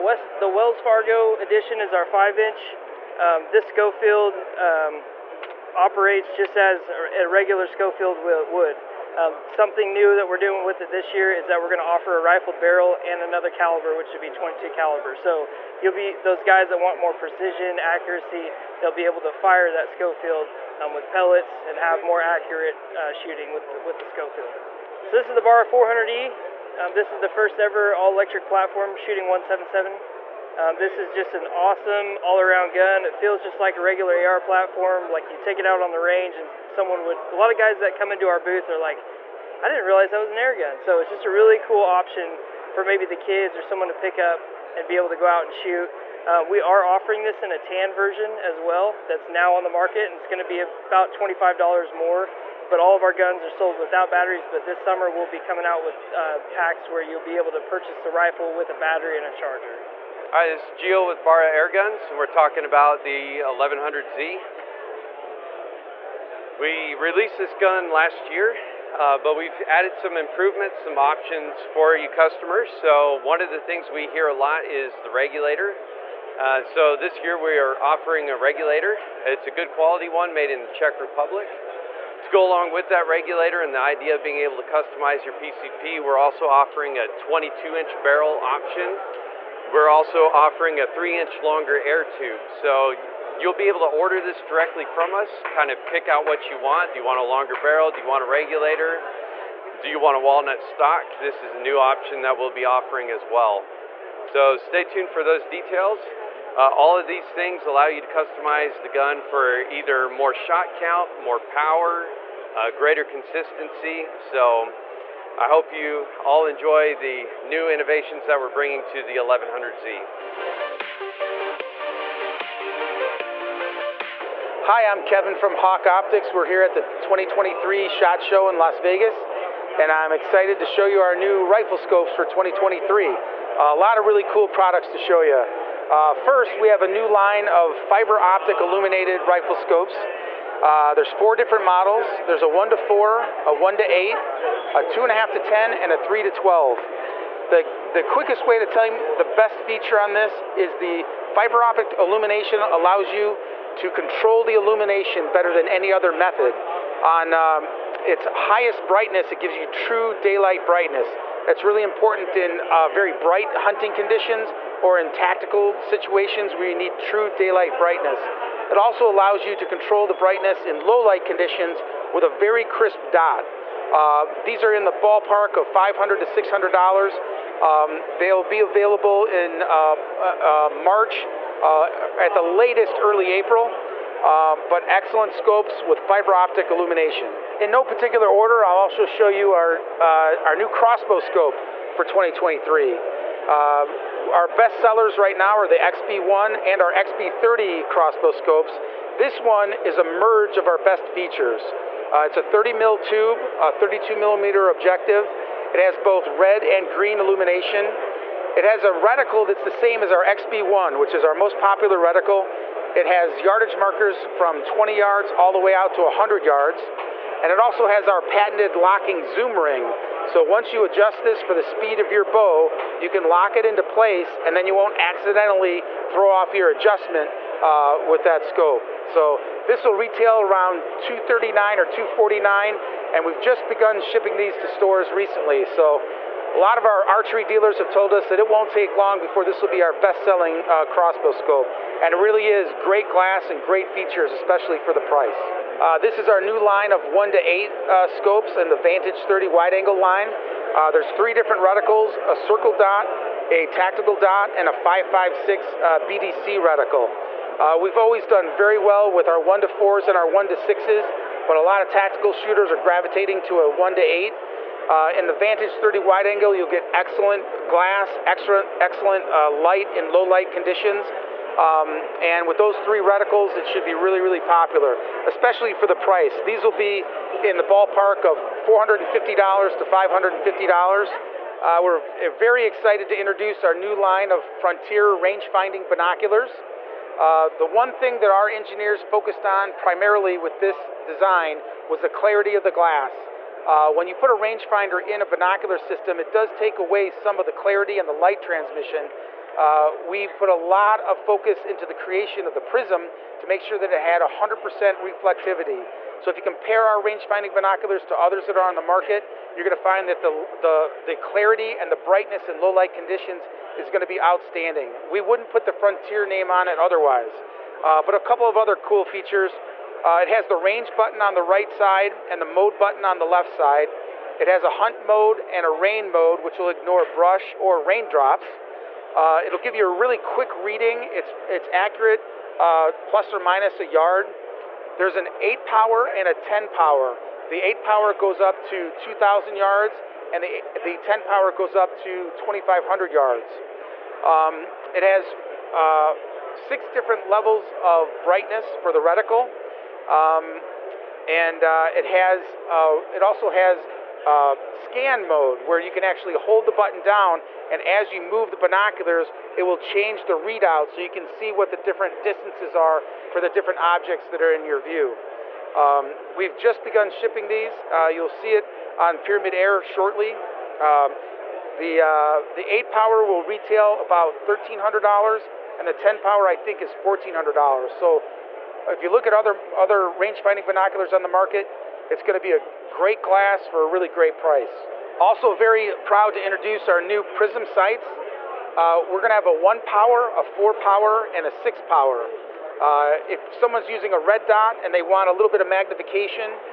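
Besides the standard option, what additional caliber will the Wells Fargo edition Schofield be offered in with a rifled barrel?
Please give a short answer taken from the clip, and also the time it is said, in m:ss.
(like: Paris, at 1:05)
22 caliber, at 0:14.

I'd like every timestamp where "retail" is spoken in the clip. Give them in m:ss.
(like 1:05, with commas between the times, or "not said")
3:49, 6:13.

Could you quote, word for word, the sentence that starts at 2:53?
Um, these are in the ballpark of $500 to $600.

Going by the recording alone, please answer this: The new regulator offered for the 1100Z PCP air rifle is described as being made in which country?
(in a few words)
Czech Republic.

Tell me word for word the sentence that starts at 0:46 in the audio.
Uh, we are offering this in a tan version as well.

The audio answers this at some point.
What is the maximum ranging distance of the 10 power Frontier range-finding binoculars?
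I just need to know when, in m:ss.
5:42.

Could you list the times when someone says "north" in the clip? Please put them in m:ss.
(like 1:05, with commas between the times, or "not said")
not said.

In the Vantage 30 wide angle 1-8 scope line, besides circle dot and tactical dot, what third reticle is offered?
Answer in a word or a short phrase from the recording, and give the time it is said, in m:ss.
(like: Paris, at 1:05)
5.56 BDC, at 4:14.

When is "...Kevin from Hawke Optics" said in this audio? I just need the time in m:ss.
2:05.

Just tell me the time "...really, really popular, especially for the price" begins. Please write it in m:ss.
4:33.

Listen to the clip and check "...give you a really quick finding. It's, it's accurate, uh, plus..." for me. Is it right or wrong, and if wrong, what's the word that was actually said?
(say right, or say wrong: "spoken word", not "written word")
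wrong: "reading", not "finding".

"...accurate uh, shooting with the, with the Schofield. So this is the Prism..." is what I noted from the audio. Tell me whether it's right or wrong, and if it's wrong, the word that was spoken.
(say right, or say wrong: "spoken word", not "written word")
wrong: "Barra", not "Prism".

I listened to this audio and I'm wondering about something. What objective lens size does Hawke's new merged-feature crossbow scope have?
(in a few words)
32 millimeter.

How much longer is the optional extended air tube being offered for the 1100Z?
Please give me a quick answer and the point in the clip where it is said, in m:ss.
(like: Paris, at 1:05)
3 inch, at 1:30.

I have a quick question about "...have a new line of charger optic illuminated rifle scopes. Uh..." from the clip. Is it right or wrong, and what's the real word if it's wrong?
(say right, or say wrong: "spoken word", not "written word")
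wrong: "fiber", not "charger".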